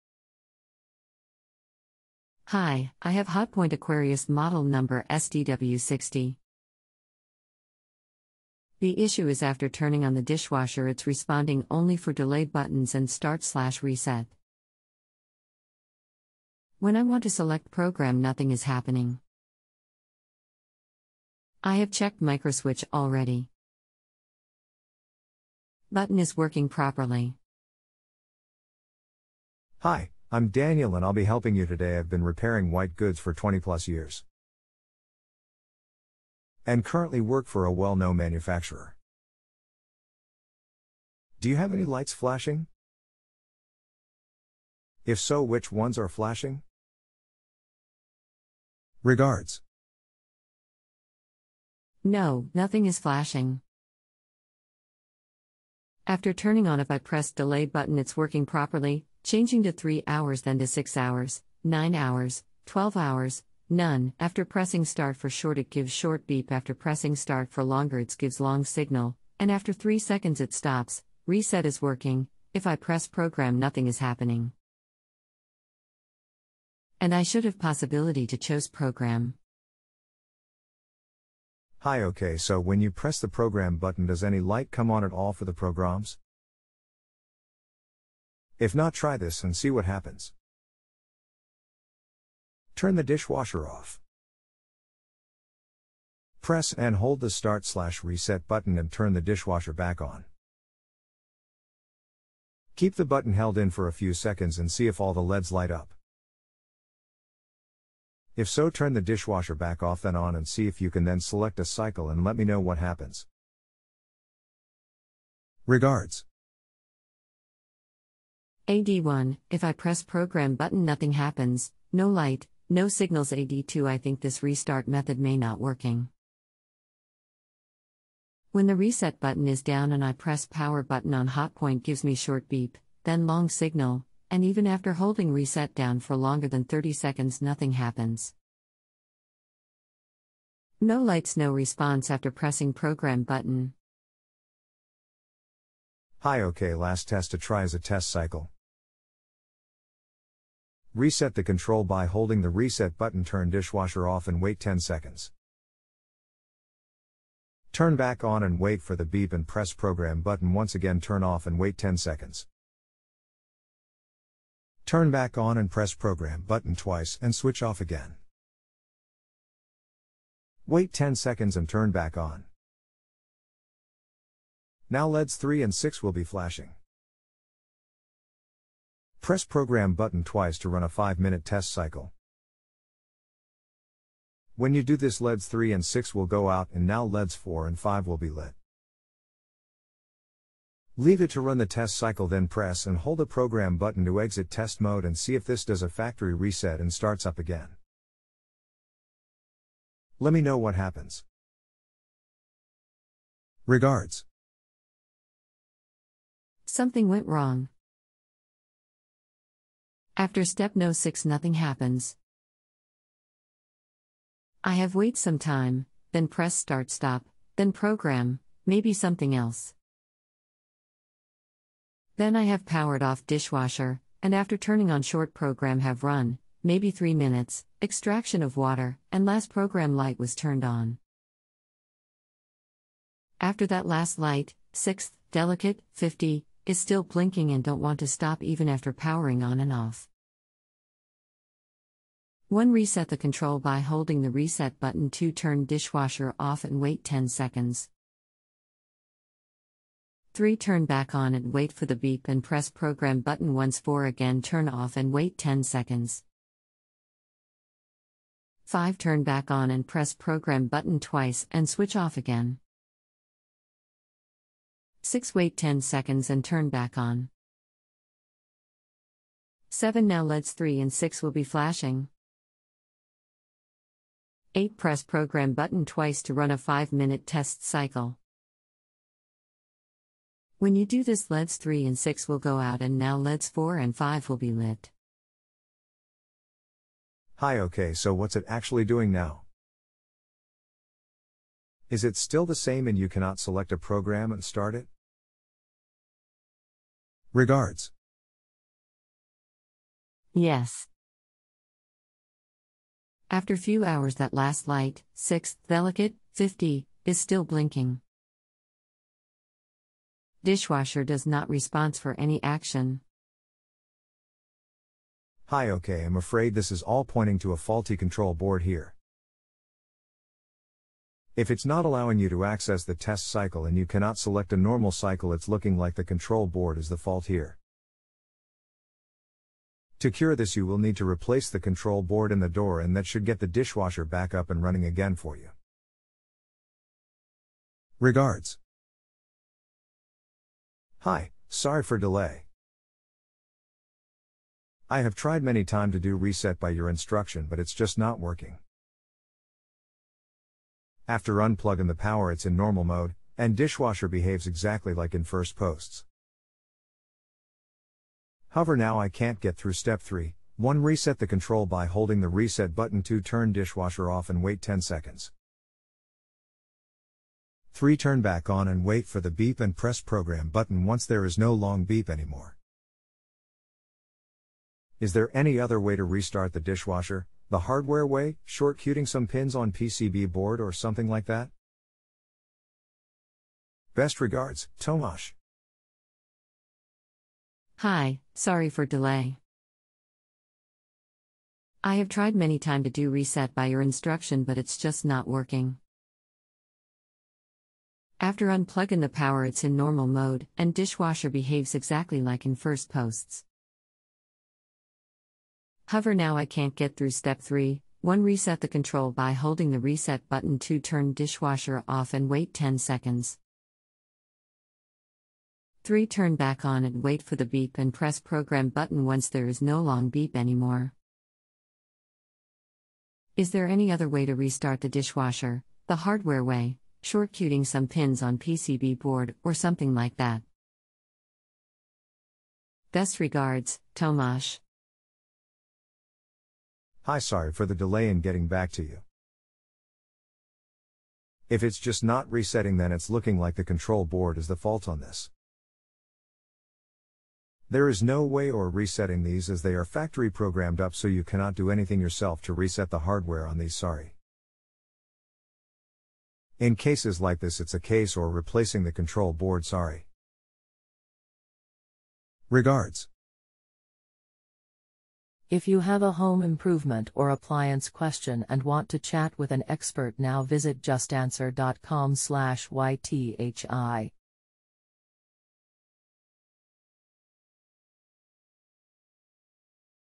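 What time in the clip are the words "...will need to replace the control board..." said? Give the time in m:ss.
5:30.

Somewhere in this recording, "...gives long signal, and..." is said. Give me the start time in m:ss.
1:08.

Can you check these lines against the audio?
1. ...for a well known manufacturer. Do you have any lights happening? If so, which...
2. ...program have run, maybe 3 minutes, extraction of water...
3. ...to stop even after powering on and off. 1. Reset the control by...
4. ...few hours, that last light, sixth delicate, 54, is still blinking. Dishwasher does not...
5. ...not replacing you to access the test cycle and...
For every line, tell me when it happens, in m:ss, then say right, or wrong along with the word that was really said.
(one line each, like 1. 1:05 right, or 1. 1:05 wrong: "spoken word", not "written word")
1. 0:37 wrong: "flashing", not "happening"
2. 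3:45 right
3. 3:58 right
4. 5:03 wrong: "50", not "54"
5. 5:21 wrong: "allowing", not "replacing".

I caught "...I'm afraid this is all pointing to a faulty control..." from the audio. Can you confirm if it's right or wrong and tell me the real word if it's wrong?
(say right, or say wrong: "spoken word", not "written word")
right.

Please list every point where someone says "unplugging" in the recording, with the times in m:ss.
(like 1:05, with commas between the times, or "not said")
5:51, 6:38.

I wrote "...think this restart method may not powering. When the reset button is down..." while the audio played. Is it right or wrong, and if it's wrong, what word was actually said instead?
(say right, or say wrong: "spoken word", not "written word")
wrong: "working", not "powering".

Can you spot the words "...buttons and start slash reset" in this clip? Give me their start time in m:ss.
0:12.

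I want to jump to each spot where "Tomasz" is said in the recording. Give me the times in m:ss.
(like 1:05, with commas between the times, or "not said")
6:24, 7:13.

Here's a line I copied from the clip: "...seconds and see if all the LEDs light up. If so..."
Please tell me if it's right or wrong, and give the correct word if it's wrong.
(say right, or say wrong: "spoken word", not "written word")
right.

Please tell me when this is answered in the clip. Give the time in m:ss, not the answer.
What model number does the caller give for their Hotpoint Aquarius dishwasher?
0:05.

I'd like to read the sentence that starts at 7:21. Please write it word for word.
If it's just not resetting, then it's looking like the control board is the fault on this.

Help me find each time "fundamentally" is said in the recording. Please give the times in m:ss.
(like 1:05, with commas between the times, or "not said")
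not said.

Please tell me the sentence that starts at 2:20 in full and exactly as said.
No lights no response after pressing program button.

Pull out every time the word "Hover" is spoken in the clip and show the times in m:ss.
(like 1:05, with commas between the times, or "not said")
5:58, 6:45.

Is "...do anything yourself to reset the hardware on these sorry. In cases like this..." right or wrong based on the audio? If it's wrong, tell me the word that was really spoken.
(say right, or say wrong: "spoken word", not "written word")
right.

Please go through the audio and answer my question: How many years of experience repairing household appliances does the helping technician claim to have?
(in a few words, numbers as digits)
20 plus years.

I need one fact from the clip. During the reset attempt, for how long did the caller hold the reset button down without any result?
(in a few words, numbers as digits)
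30 seconds.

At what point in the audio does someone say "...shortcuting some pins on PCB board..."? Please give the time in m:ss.
7:07.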